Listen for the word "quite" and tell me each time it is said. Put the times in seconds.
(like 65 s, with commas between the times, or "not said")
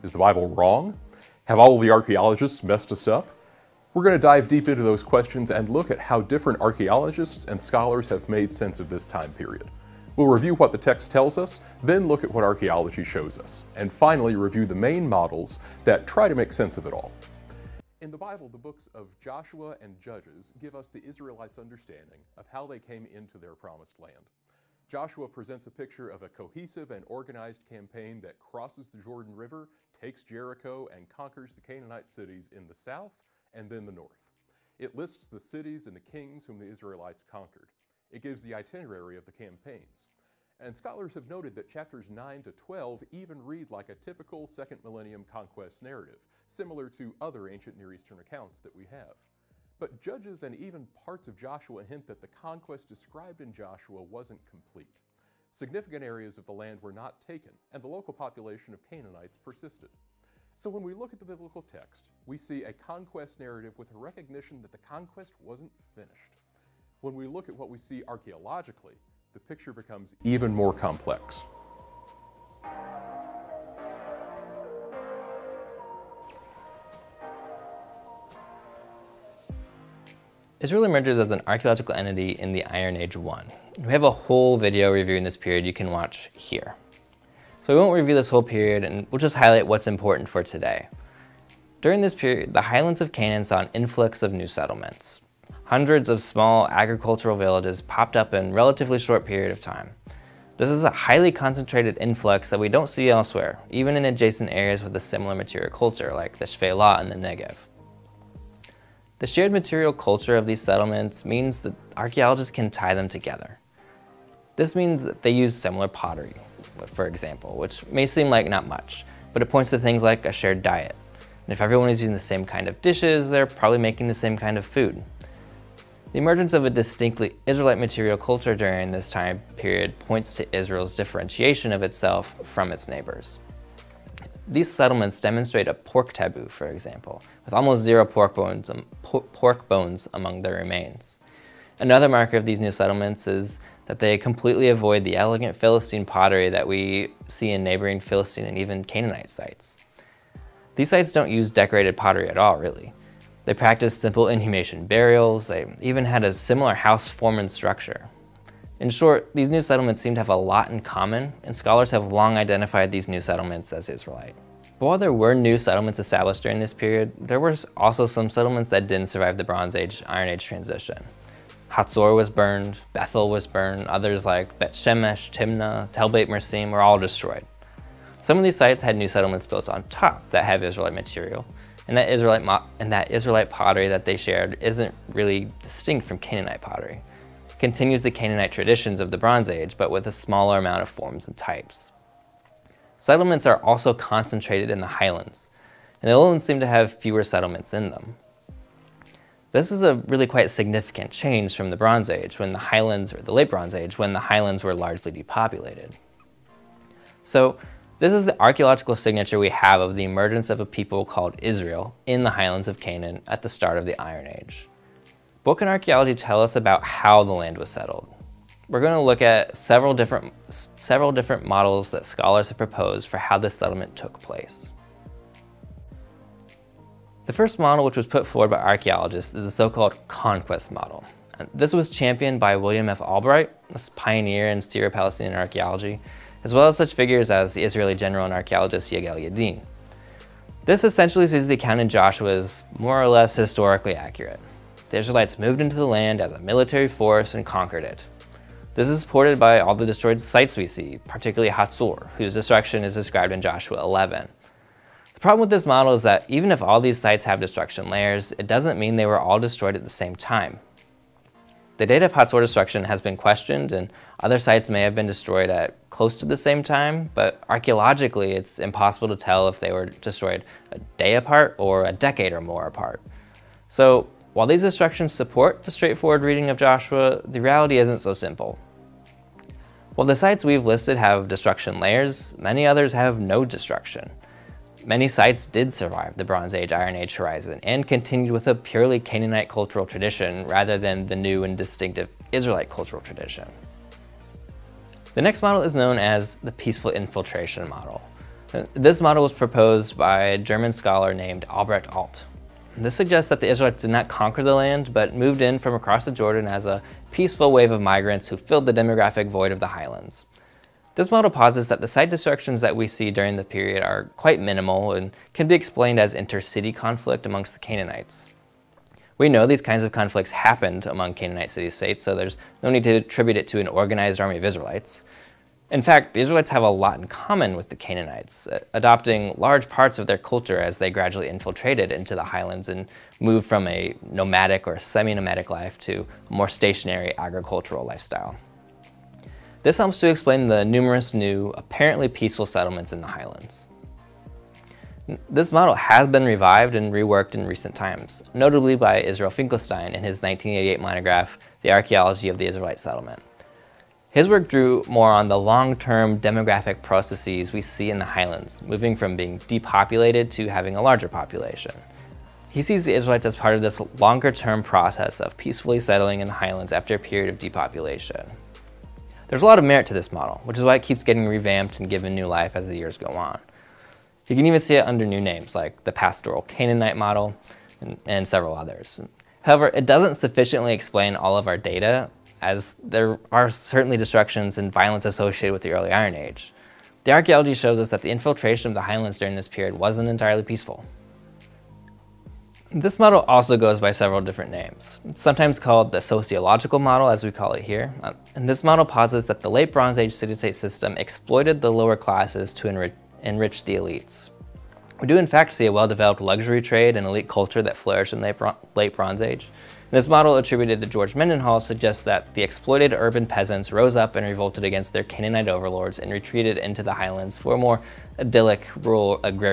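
200 s, 314 s.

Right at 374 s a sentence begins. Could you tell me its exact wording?
You can even see it under new names like the Pastoral Canaanite model and, and several others.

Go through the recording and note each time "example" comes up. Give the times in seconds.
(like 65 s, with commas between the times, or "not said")
117 s, 136 s.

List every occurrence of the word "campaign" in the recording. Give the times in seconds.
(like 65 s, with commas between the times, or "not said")
27 s, 39 s.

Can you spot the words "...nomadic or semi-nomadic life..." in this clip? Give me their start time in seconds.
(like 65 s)
334 s.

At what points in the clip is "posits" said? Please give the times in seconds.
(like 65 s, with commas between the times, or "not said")
311 s, 398 s.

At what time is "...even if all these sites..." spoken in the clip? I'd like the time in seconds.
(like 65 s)
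256 s.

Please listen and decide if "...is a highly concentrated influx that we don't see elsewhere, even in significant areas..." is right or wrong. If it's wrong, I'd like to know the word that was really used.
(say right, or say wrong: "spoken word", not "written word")
wrong: "adjacent", not "significant".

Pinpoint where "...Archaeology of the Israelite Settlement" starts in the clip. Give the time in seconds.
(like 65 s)
351 s.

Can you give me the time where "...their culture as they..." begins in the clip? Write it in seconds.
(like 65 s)
330 s.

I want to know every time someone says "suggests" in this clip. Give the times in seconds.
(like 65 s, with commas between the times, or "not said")
302 s, 411 s.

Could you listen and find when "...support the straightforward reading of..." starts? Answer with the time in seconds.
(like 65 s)
275 s.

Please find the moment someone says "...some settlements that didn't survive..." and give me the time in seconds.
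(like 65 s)
168 s.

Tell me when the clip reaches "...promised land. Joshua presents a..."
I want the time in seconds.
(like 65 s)
23 s.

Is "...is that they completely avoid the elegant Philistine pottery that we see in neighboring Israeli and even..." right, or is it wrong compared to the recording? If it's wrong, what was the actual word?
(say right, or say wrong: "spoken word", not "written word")
wrong: "Philistine", not "Israeli".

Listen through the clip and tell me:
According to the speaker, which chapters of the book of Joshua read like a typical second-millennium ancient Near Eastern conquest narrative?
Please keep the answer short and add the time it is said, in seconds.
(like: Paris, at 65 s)
Chapters 9 to 12, at 41 s.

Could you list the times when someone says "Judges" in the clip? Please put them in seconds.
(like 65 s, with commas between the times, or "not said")
19 s, 49 s.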